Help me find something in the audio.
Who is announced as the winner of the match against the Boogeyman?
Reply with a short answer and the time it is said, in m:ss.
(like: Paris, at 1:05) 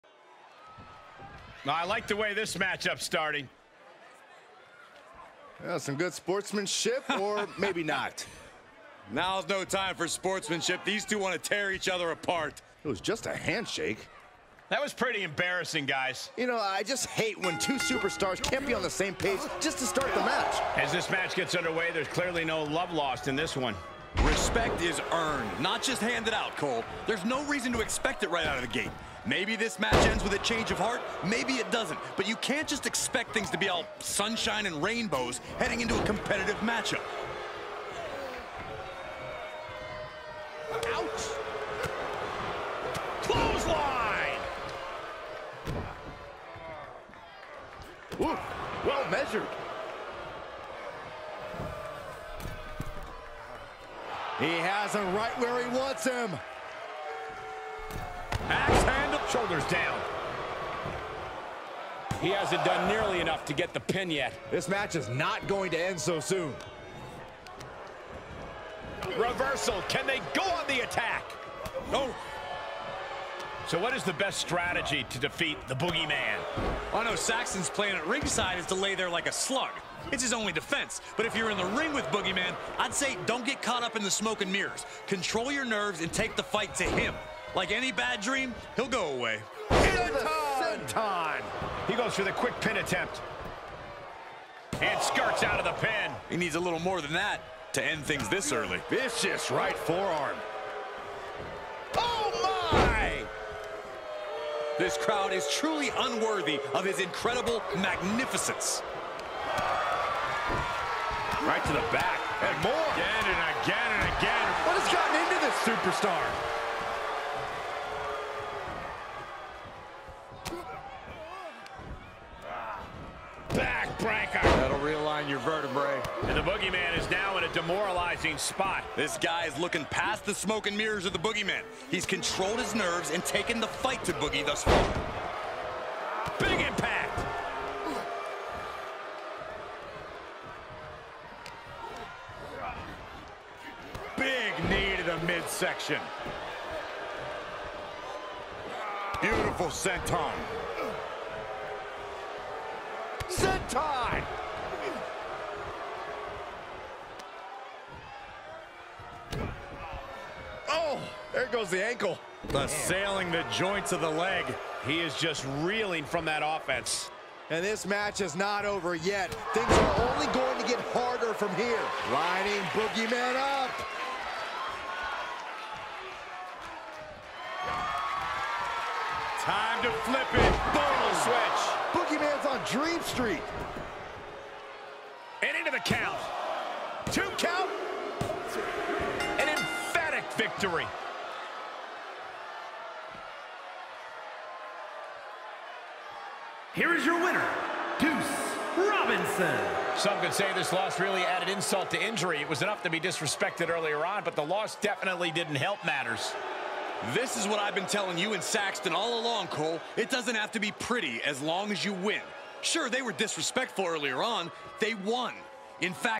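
Juice Robinson, at 3:17.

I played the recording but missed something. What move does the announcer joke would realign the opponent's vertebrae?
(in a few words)
Backbreaker.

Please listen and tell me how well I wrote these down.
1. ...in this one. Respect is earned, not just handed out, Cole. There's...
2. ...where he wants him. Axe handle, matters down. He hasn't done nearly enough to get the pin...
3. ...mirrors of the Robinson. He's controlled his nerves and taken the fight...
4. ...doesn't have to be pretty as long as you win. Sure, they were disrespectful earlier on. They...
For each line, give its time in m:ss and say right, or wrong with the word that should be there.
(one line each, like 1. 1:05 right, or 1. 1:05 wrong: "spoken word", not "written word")
1. 0:23 right
2. 0:55 wrong: "shoulders", not "matters"
3. 2:10 wrong: "Boogeyman", not "Robinson"
4. 3:30 right.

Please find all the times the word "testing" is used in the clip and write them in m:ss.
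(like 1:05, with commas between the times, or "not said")
not said.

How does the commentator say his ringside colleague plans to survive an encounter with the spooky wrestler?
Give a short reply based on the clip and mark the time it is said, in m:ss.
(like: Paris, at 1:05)
Lay there like a slug, at 1:18.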